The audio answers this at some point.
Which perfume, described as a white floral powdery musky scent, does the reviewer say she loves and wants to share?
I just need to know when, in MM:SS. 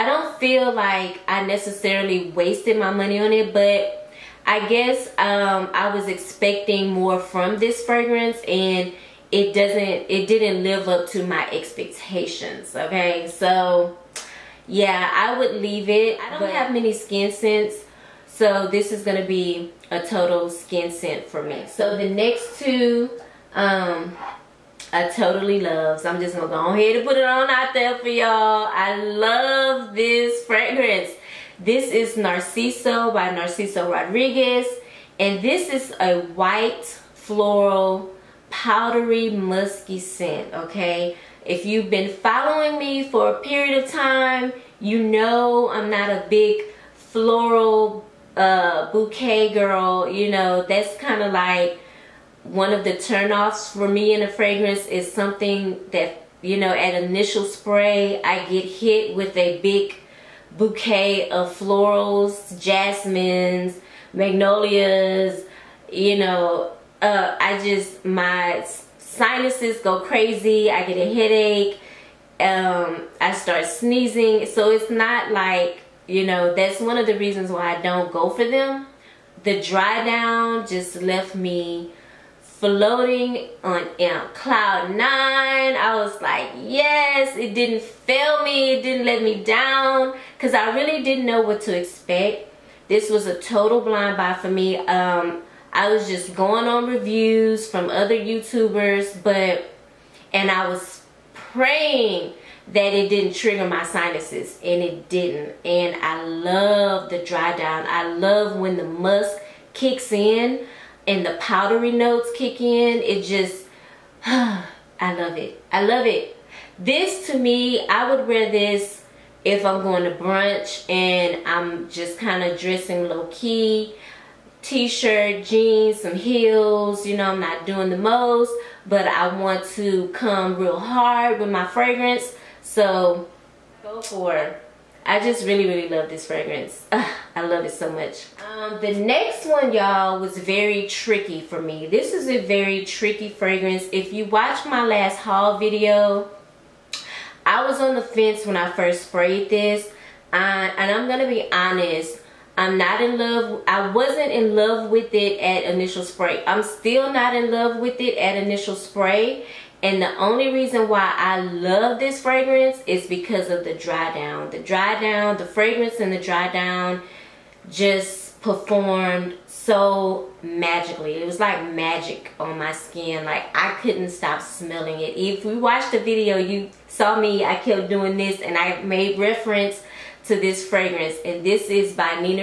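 00:32.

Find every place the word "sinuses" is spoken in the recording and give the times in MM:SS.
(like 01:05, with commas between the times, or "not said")
01:08, 01:43.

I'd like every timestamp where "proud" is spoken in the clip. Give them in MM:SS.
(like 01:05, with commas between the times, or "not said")
not said.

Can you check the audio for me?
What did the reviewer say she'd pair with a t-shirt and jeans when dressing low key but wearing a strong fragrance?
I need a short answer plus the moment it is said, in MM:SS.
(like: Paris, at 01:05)
Heels, at 02:06.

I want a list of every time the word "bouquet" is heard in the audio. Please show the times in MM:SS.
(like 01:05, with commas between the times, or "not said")
00:48, 01:00.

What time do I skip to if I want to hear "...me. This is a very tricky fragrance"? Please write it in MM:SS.
02:21.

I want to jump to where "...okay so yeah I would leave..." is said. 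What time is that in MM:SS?
00:12.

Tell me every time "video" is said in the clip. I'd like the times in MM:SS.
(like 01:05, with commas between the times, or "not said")
02:25, 02:55.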